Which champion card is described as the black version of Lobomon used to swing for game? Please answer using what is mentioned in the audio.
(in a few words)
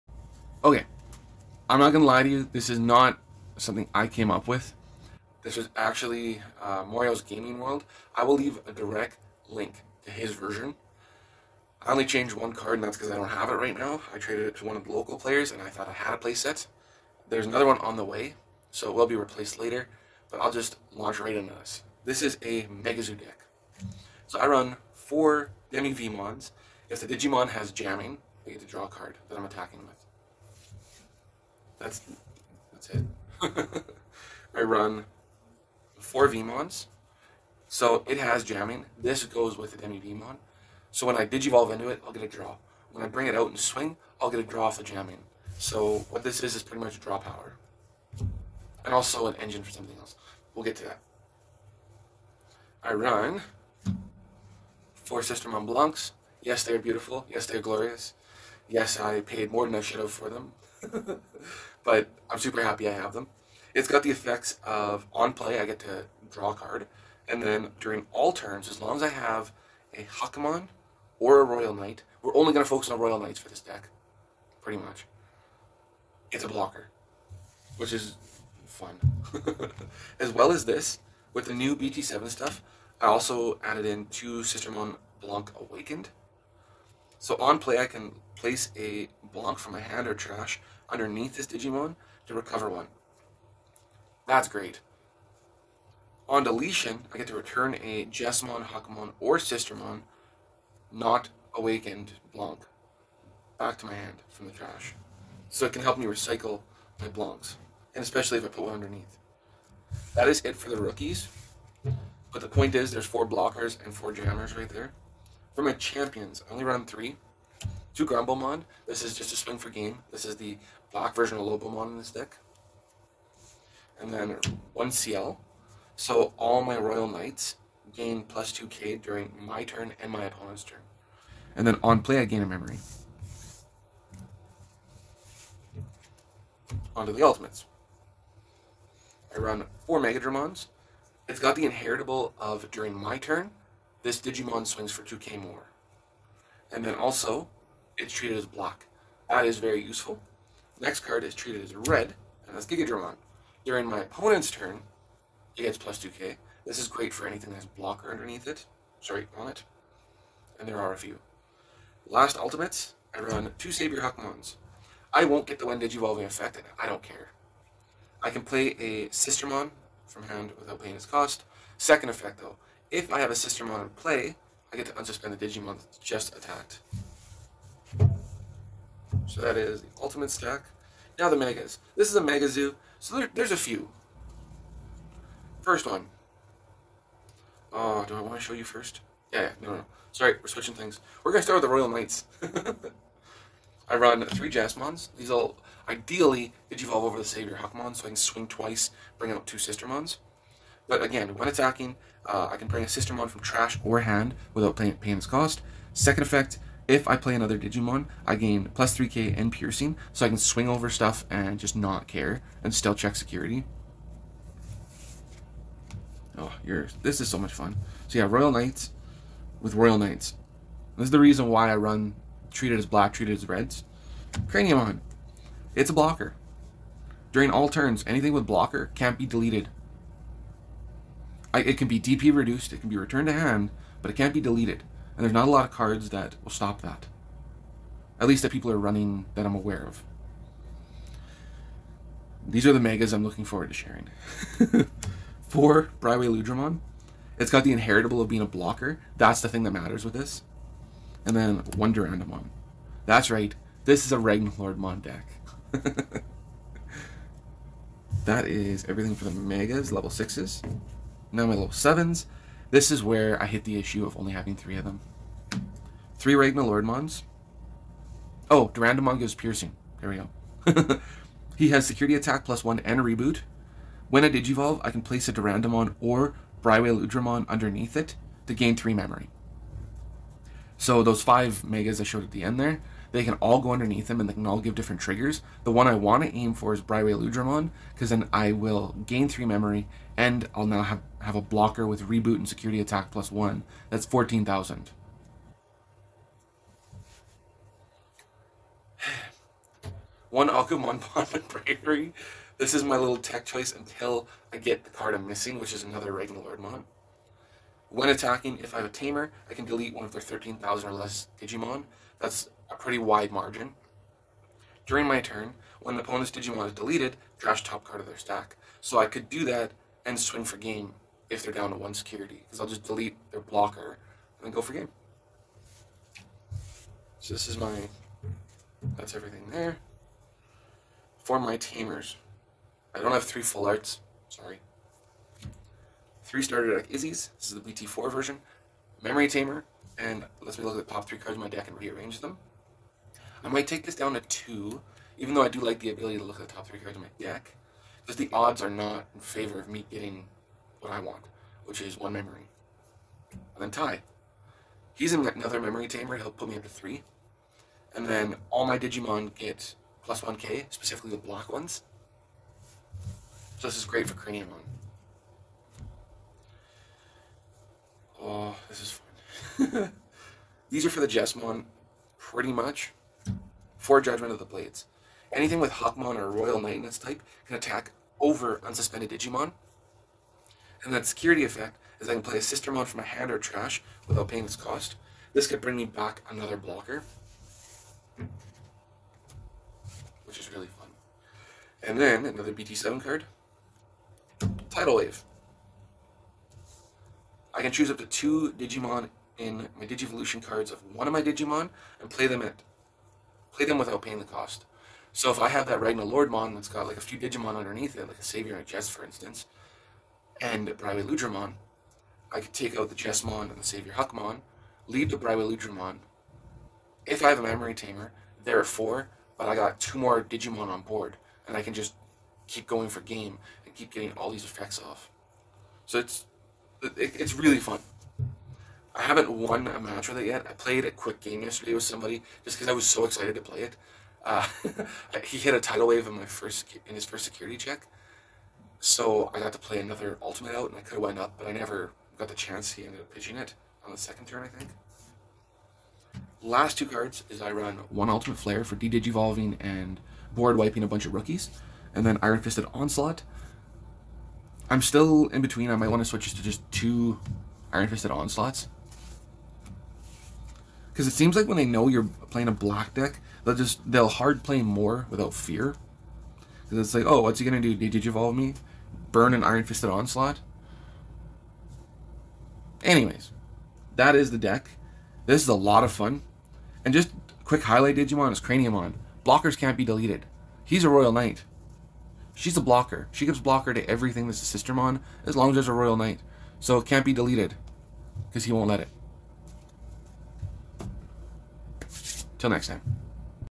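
Grumblemon.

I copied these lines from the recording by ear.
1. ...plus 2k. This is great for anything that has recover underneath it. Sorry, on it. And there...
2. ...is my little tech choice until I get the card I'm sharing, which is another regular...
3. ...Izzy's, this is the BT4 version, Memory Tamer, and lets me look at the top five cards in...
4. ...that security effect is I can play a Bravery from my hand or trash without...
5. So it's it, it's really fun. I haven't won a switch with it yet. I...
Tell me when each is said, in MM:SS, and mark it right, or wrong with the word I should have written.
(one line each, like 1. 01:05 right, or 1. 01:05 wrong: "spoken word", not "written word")
1. 02:35 wrong: "blocker", not "recover"
2. 05:02 wrong: "missing", not "sharing"
3. 05:36 wrong: "three", not "five"
4. 06:20 wrong: "Sistermon", not "Bravery"
5. 07:05 wrong: "match", not "switch".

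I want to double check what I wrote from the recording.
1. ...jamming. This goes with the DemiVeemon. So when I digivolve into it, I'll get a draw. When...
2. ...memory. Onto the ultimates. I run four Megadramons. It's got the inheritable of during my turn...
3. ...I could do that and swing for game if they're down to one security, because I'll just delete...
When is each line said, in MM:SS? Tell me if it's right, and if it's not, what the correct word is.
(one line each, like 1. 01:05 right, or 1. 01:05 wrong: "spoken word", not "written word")
1. 00:38 right
2. 02:12 right
3. 05:18 right.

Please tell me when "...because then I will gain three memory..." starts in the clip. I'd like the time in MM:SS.
04:47.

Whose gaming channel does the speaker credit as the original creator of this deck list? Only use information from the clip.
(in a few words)
Mario's Gaming World.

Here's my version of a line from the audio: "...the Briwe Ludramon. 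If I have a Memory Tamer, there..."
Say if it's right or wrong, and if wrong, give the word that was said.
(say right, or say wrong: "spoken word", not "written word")
right.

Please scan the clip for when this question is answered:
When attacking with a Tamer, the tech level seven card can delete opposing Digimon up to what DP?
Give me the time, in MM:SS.
05:10.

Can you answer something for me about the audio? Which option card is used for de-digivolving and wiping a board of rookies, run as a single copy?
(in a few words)
Ultimate Flare.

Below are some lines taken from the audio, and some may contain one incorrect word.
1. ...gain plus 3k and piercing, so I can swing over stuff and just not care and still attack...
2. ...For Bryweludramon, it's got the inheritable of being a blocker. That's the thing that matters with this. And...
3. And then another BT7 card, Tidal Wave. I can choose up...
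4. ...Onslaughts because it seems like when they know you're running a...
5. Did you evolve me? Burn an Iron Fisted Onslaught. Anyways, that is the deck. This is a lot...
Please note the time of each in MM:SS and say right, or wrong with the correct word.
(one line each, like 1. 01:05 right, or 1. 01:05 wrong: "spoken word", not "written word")
1. 03:28 wrong: "check", not "attack"
2. 04:05 right
3. 06:31 right
4. 07:38 wrong: "playing", not "running"
5. 07:47 right.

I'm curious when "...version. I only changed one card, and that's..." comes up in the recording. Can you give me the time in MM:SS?
00:10.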